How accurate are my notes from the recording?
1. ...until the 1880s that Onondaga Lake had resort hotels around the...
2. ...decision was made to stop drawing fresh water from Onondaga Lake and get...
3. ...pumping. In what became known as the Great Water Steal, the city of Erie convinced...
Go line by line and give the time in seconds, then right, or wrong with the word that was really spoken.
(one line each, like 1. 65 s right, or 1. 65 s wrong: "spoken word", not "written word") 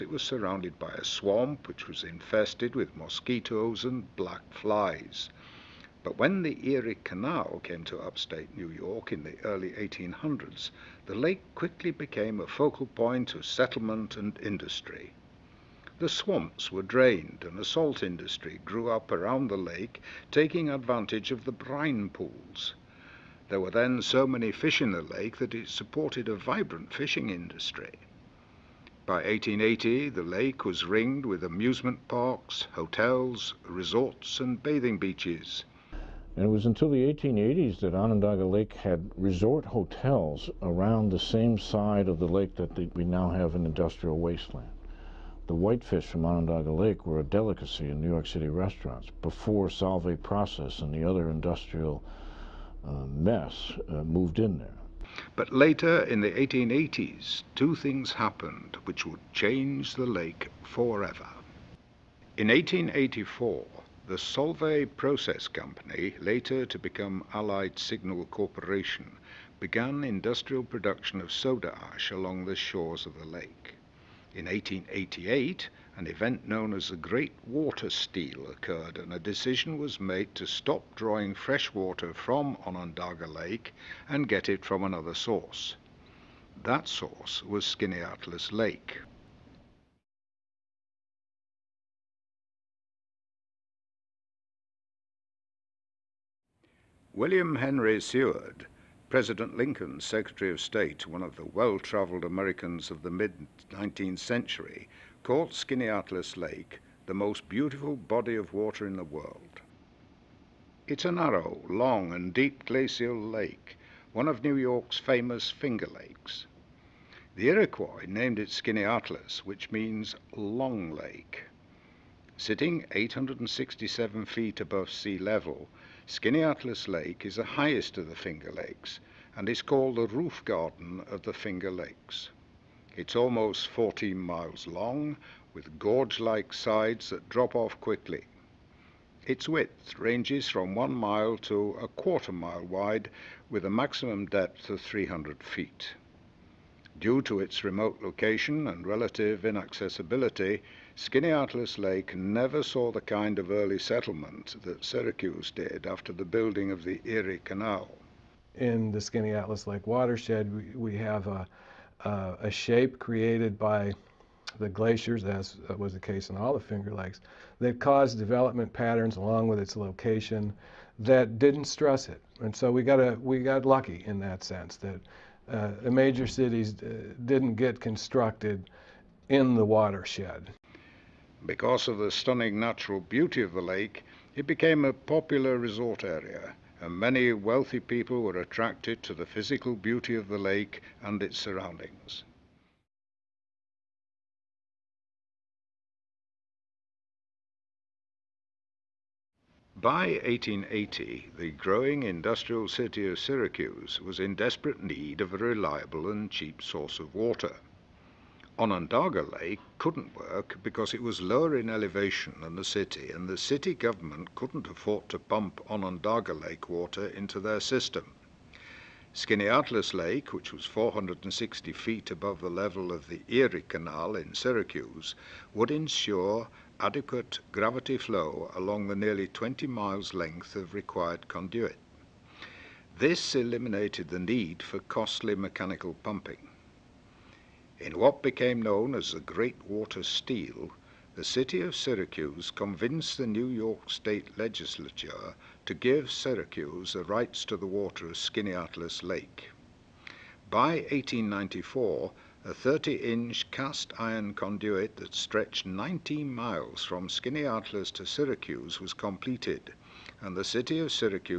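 1. 36 s right
2. 79 s right
3. 236 s wrong: "Syracuse", not "Erie".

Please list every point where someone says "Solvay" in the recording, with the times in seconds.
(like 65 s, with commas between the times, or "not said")
49 s, 64 s.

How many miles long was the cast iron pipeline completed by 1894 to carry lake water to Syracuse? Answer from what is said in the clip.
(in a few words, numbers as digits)
19 miles.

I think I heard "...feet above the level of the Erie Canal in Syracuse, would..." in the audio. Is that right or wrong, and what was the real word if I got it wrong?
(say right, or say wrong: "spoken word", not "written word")
right.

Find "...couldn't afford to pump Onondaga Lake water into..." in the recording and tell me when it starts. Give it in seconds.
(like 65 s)
214 s.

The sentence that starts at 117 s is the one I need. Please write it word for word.
The Iroquois named it Skaneateles, which means Long Lake.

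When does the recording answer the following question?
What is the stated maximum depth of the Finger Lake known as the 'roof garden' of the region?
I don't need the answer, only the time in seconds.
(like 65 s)
144 s.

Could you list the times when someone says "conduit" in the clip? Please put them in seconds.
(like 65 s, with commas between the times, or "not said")
231 s, 254 s.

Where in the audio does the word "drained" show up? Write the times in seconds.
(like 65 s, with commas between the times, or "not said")
16 s.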